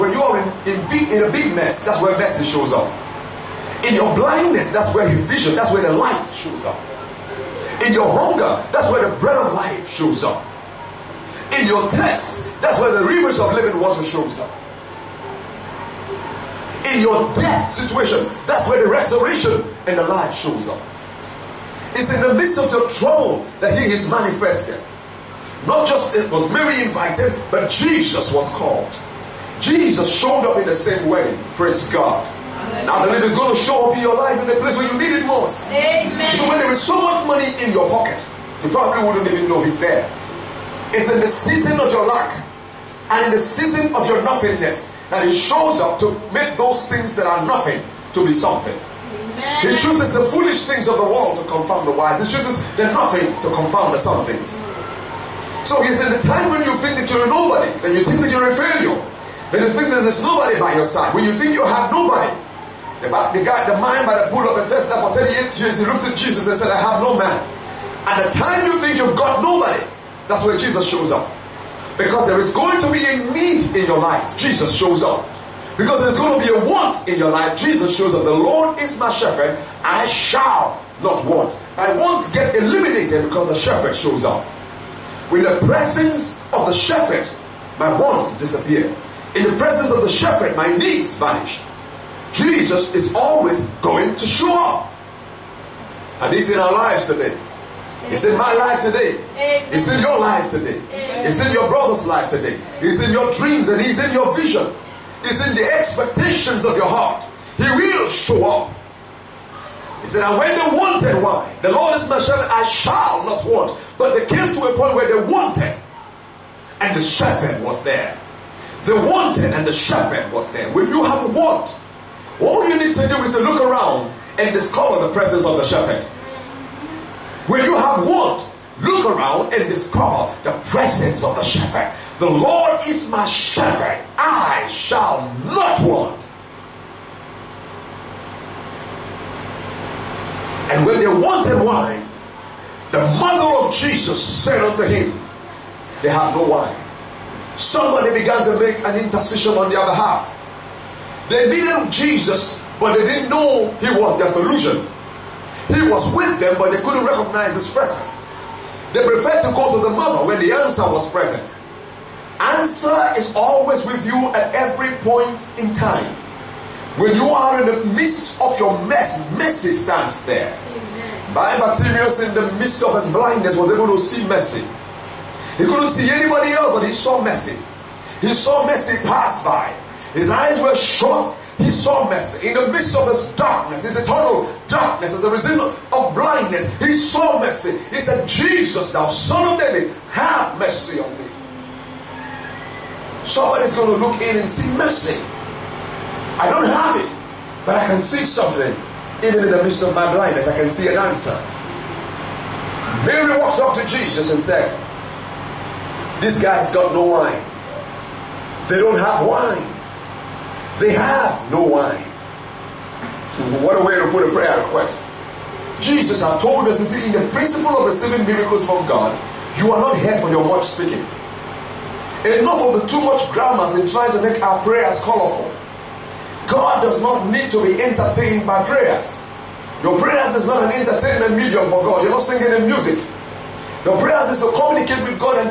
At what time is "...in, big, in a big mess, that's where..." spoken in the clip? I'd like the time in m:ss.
0:00.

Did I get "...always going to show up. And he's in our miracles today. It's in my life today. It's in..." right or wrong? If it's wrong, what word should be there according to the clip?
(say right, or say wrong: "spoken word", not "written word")
wrong: "lives", not "miracles".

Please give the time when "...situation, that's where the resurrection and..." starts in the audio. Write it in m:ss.
0:17.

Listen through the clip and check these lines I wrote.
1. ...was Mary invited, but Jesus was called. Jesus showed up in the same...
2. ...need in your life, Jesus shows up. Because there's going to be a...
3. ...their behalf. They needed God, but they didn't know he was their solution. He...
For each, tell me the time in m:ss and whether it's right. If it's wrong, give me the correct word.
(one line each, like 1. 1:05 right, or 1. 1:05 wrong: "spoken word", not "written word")
1. 0:26 right
2. 1:13 right
3. 2:29 wrong: "Jesus", not "God".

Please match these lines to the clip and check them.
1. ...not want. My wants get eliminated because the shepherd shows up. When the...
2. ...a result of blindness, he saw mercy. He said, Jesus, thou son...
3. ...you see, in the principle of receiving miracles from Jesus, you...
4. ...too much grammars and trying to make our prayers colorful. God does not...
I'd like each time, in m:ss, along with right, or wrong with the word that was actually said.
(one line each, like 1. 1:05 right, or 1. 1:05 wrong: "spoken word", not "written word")
1. 1:21 right
2. 3:05 right
3. 3:36 wrong: "God", not "Jesus"
4. 3:42 right.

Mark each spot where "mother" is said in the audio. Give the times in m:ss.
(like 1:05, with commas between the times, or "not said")
2:23, 2:39.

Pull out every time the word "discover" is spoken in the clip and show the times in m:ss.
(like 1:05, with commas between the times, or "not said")
2:04, 2:09.